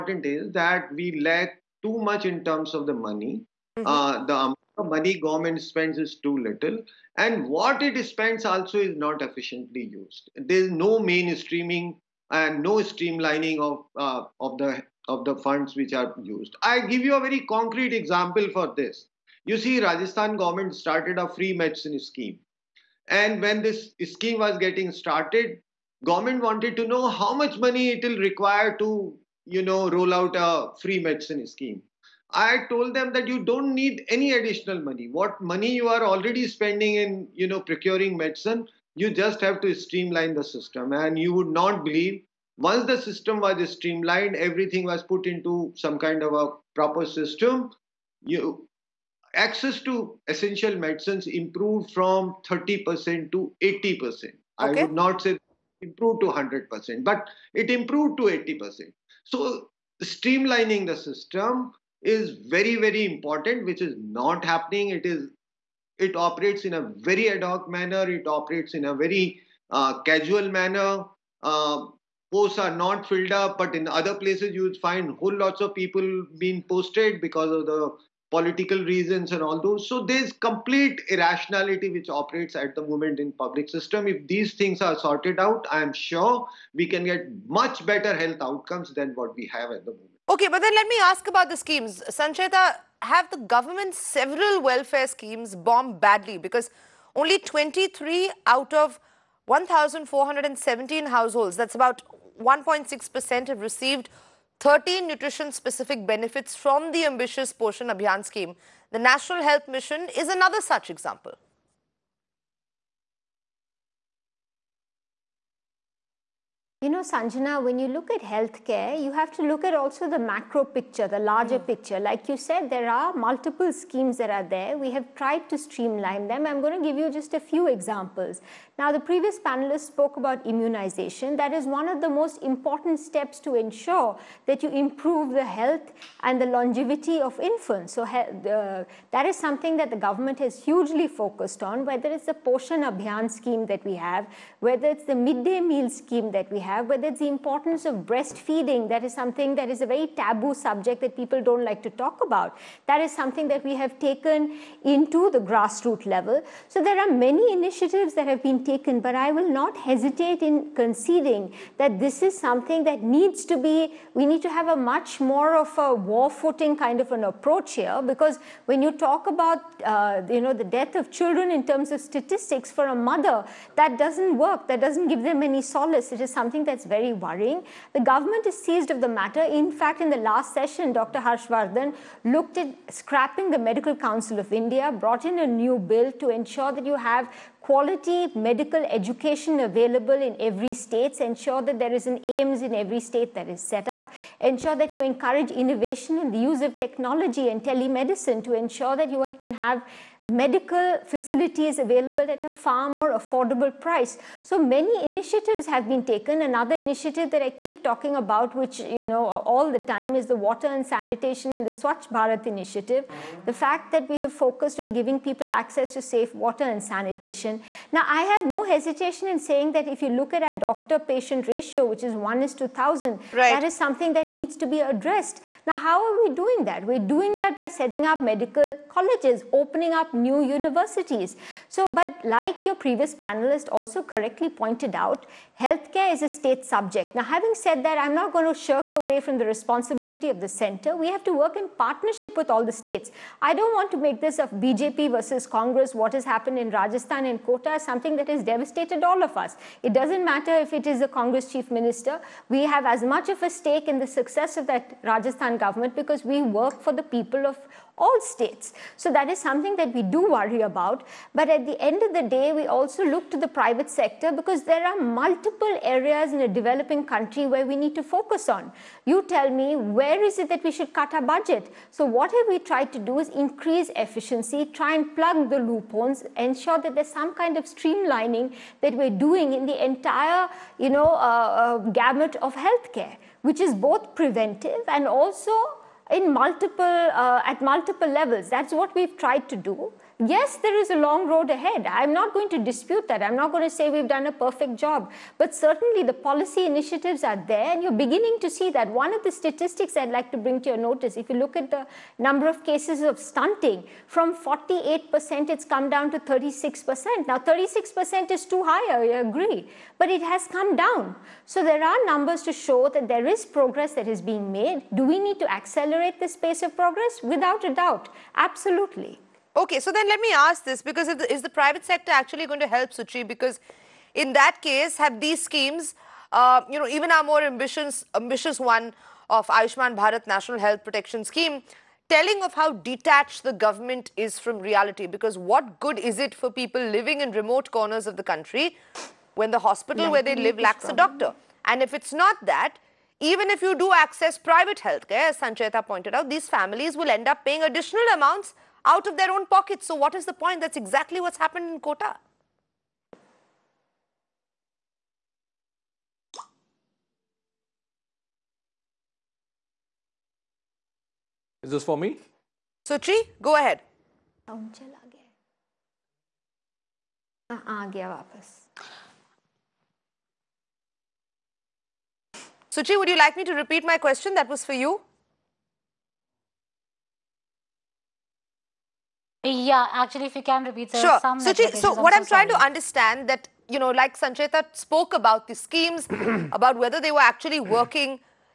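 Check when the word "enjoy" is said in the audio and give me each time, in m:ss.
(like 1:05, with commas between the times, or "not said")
not said.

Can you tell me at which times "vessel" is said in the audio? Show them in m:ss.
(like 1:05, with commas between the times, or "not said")
not said.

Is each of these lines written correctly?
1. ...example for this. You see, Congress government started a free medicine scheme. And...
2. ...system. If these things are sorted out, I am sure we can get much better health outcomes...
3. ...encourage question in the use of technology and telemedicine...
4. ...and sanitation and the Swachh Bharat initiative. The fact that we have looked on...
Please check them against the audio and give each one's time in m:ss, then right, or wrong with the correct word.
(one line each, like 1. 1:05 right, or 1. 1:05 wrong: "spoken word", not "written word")
1. 0:17 wrong: "Rajasthan", not "Congress"
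2. 1:23 right
3. 3:14 wrong: "innovation", not "question"
4. 3:30 wrong: "focused", not "looked".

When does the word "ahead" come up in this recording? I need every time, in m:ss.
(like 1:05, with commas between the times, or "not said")
4:51, 6:03.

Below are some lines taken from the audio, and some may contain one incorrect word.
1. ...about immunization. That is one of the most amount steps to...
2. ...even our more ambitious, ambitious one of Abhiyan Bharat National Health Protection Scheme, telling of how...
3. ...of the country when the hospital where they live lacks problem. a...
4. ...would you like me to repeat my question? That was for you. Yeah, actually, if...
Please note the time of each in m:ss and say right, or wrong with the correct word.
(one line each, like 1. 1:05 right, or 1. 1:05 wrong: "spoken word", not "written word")
1. 2:10 wrong: "important", not "amount"
2. 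5:26 wrong: "Ayushman", not "Abhiyan"
3. 5:38 right
4. 6:12 right.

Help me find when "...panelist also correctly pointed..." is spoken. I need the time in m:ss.
3:53.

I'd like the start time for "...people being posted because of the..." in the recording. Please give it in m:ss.
1:15.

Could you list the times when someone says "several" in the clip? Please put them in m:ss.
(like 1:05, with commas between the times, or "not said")
1:33.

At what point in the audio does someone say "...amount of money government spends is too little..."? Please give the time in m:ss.
0:04.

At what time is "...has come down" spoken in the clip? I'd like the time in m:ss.
5:10.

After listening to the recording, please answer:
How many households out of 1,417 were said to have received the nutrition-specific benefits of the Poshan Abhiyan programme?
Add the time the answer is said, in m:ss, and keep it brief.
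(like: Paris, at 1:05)
23, at 1:37.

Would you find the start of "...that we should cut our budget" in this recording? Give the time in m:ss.
4:30.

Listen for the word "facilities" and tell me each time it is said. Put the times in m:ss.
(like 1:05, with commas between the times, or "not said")
3:21.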